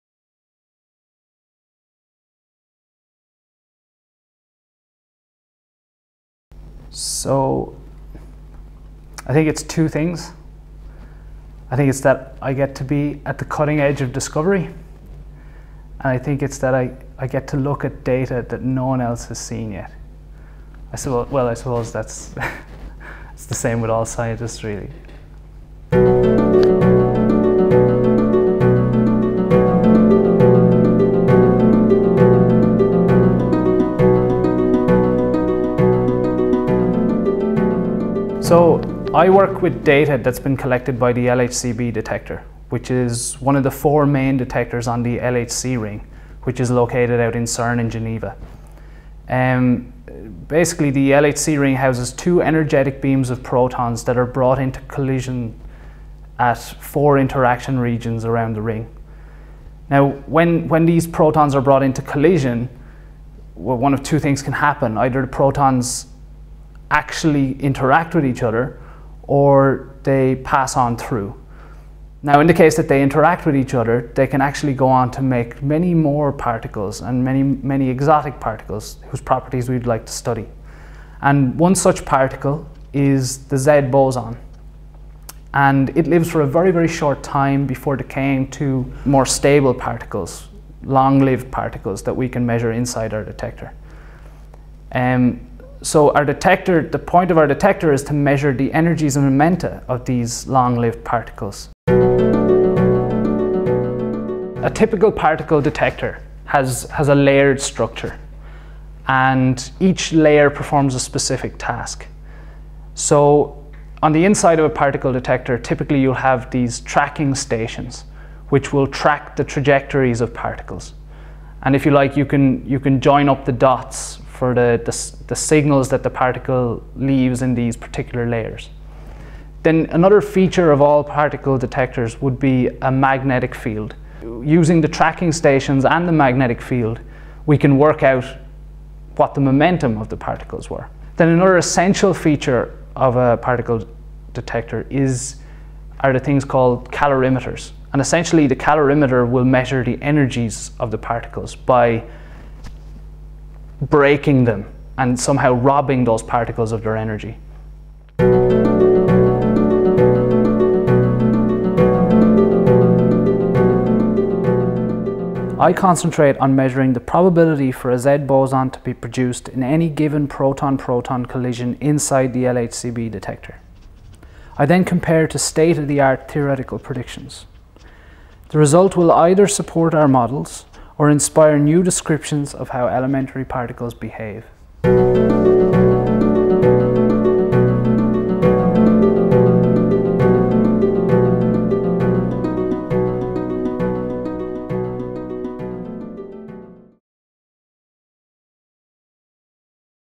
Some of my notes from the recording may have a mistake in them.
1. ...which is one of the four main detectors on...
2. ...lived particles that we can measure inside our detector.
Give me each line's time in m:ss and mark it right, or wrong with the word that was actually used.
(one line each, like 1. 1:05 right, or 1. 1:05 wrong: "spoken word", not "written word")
1. 0:42 right
2. 1:31 right.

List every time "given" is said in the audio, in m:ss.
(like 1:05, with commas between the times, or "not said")
2:49.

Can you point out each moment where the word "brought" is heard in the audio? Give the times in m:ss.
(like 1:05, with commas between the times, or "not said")
0:54, 1:01.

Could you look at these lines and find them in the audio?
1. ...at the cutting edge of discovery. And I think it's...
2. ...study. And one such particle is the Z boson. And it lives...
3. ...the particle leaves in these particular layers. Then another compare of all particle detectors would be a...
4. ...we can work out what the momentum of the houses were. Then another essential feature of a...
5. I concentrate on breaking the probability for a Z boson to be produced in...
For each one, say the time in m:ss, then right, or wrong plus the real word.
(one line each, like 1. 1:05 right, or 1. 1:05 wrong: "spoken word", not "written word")
1. 0:13 right
2. 1:20 right
3. 2:06 wrong: "feature", not "compare"
4. 2:17 wrong: "particles", not "houses"
5. 2:45 wrong: "measuring", not "breaking".